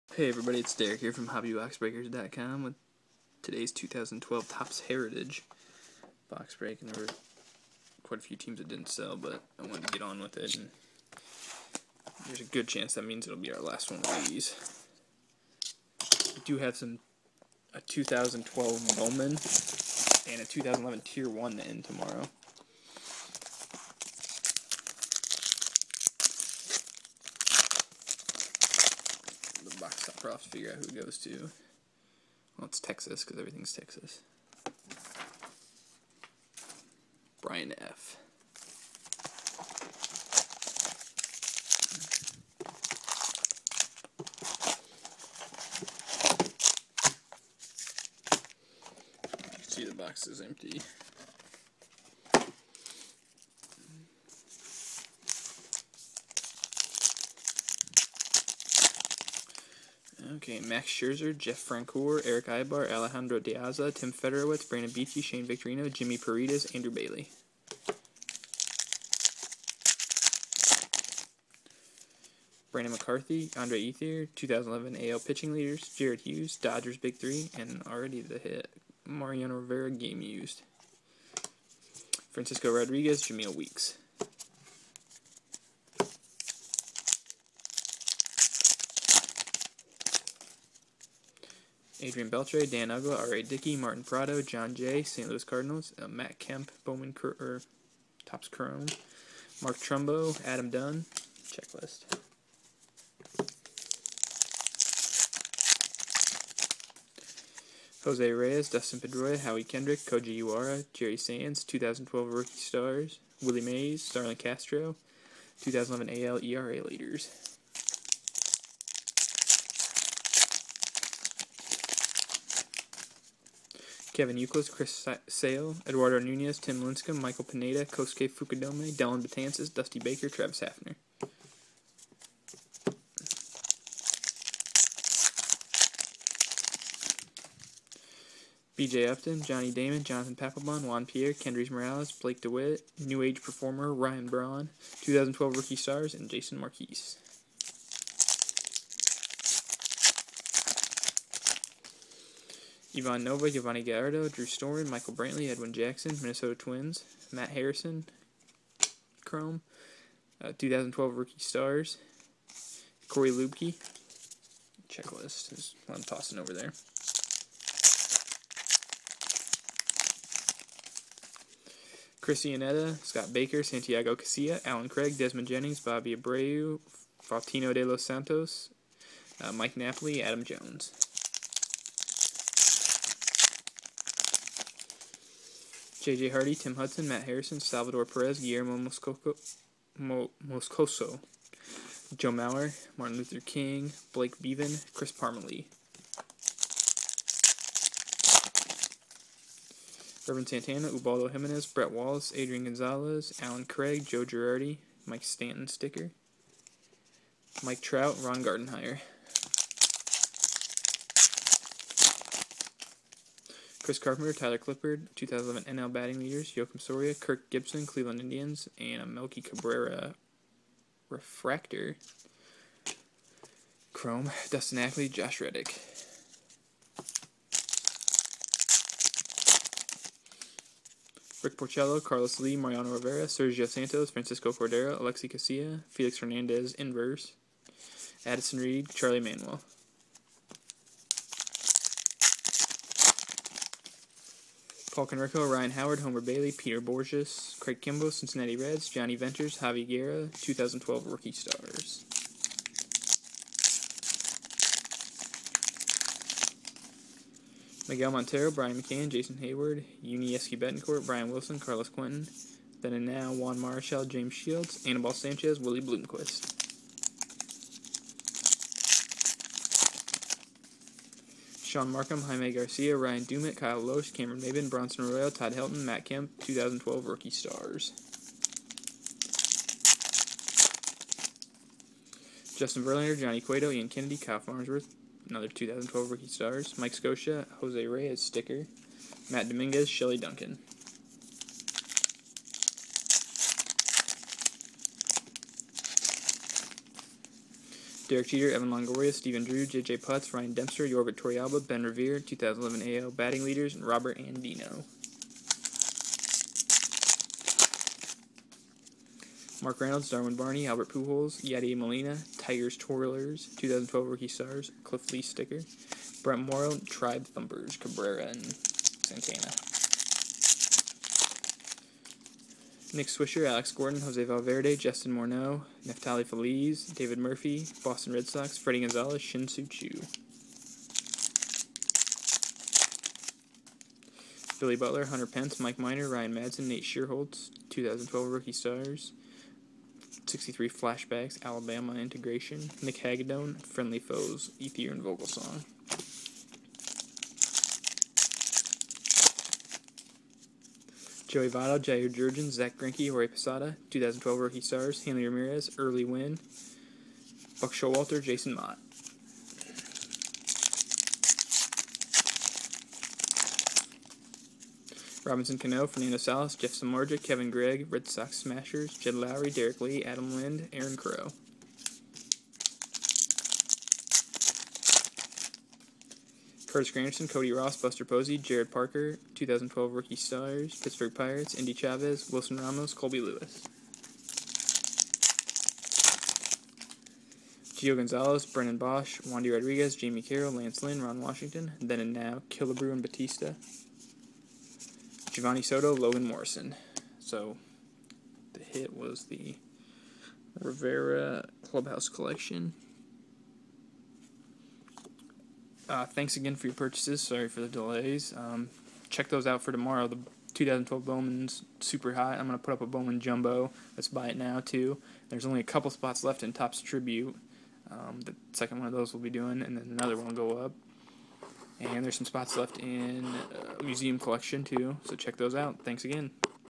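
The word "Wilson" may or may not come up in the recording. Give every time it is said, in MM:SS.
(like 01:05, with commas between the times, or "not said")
04:21, 06:22.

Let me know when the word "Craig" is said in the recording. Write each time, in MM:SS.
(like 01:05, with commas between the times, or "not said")
02:54, 03:23, 04:07.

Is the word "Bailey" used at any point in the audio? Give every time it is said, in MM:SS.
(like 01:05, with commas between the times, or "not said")
01:06, 04:06.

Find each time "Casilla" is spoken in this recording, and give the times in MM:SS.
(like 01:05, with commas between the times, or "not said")
02:54, 03:55.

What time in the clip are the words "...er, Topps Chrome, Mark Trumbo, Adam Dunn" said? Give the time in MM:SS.
01:37.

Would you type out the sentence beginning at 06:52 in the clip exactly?
I'm going to put up a Bowman Jumbo.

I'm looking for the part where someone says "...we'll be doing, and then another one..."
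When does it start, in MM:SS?
06:59.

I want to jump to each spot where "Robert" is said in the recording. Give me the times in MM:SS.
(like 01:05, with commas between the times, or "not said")
05:03.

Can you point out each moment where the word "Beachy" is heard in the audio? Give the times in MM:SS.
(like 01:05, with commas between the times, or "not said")
01:04.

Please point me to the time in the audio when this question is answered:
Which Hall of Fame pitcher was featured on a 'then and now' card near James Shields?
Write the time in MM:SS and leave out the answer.
04:22.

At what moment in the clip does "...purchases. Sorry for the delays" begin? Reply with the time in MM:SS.
06:46.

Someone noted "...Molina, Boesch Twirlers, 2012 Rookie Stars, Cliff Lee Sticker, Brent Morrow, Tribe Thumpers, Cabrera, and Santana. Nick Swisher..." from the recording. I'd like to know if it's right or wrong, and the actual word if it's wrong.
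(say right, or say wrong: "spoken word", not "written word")
wrong: "Tigers", not "Boesch".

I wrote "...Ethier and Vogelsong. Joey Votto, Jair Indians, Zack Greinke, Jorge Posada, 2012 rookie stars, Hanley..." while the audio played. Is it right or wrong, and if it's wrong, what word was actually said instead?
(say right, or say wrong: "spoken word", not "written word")
wrong: "Jurrjens", not "Indians".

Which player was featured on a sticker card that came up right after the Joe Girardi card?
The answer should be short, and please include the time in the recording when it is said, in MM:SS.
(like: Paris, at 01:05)
Mike Stanton, at 03:25.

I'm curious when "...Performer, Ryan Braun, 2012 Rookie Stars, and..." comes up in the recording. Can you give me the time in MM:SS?
02:23.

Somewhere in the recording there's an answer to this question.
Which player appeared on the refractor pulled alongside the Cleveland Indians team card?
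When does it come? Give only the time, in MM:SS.
03:39.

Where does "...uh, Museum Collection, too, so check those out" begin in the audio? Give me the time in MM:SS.
07:03.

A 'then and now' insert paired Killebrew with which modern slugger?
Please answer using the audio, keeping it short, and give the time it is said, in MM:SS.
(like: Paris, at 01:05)
Bautista, at 06:32.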